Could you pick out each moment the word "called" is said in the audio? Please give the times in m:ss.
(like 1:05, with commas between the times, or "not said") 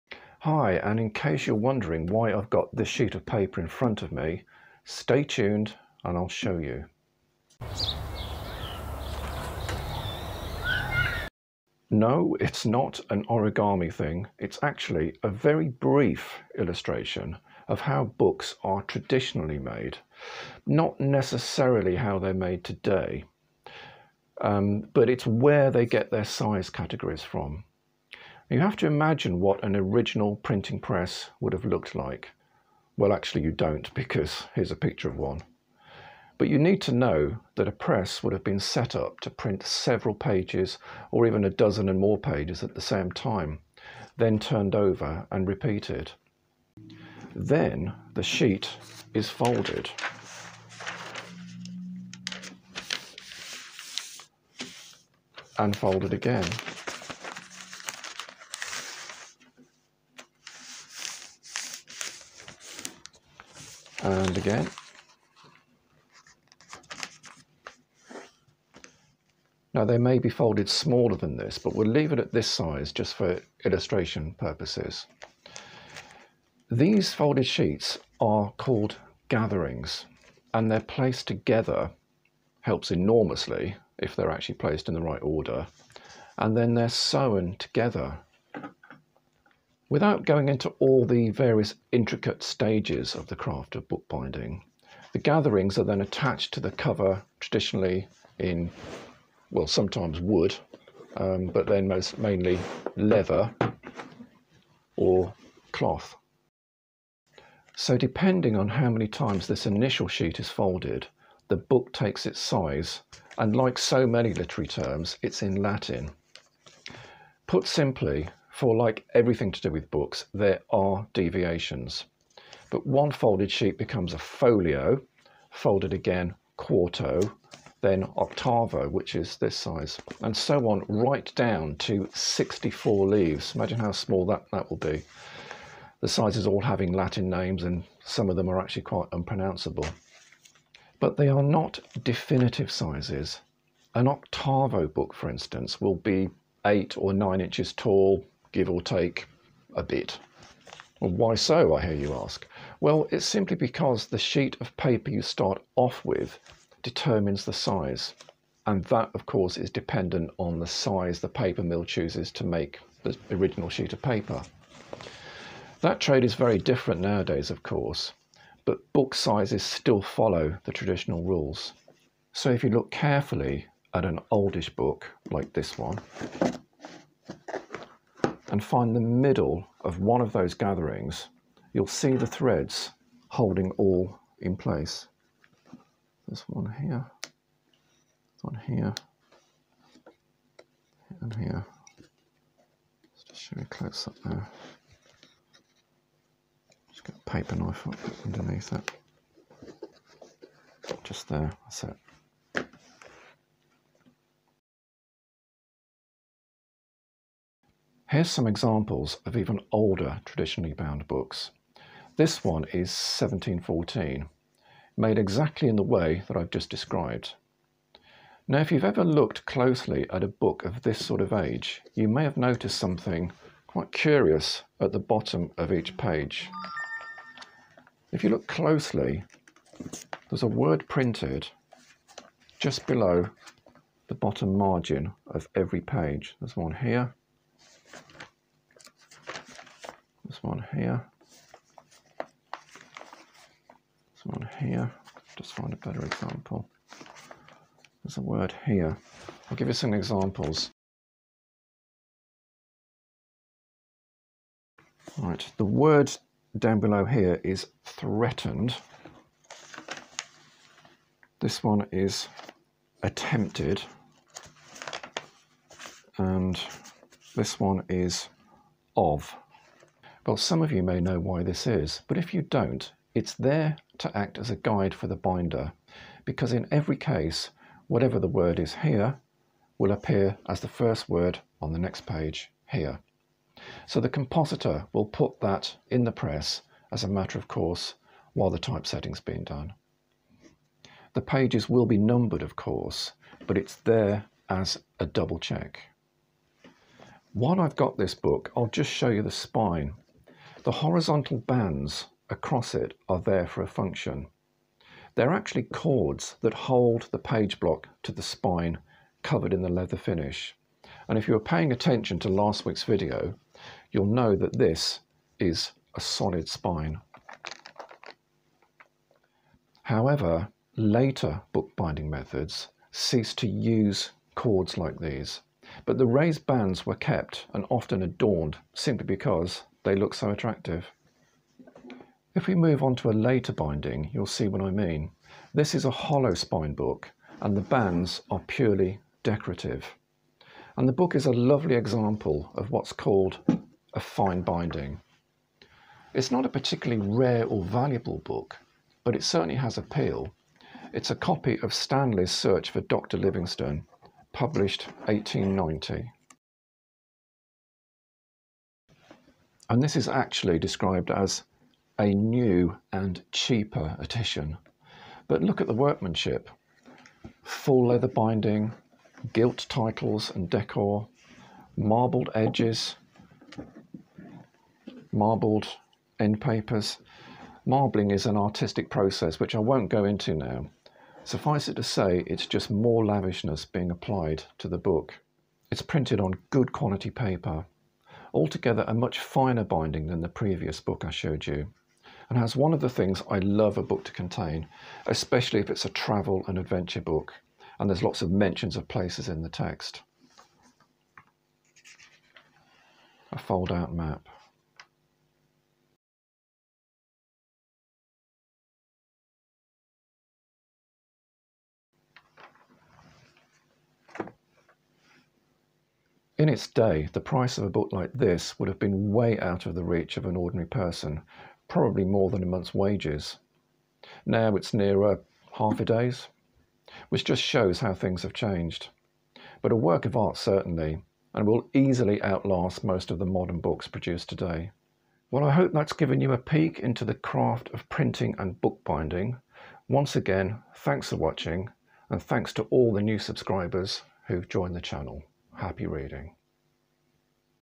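1:18, 5:42.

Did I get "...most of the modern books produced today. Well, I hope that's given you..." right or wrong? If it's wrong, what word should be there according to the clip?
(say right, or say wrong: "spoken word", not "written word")
right.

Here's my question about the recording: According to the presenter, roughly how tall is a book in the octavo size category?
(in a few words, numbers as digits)
8 or 9 inches.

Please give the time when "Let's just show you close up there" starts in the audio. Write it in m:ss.
3:11.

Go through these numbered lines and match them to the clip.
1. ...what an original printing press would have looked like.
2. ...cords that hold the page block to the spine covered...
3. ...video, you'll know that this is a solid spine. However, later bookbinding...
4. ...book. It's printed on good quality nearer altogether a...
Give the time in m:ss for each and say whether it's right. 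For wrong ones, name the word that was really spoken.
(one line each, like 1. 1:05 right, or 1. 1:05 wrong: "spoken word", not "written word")
1. 0:29 right
2. 5:05 right
3. 5:12 right
4. 6:24 wrong: "paper", not "nearer".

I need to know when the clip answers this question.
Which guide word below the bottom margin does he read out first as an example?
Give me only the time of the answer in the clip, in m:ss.
4:17.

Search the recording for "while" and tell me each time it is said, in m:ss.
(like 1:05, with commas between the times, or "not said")
4:48, 4:57.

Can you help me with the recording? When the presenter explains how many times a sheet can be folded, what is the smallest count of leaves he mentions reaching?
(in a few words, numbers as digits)
64 leaves.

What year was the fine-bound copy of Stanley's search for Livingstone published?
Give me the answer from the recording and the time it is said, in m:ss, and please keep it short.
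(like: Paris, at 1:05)
1890, at 5:55.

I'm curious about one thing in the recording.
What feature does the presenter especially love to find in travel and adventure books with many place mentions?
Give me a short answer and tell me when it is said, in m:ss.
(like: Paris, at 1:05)
A fold out map, at 6:43.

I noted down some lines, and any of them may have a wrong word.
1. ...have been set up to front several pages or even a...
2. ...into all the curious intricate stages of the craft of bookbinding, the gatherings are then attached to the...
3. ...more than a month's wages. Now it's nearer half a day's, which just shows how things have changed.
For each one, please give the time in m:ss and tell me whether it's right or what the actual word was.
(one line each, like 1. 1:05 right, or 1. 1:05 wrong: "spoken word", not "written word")
1. 0:38 wrong: "print", not "front"
2. 1:30 wrong: "various", not "curious"
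3. 7:02 right.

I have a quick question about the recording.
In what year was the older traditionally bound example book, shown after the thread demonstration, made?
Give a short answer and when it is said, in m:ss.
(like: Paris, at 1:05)
1714, at 3:32.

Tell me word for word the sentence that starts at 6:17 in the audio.
Marbling is an artistic process which I won't go into now.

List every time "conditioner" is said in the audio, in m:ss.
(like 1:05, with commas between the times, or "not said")
not said.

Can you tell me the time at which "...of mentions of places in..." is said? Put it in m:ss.
6:38.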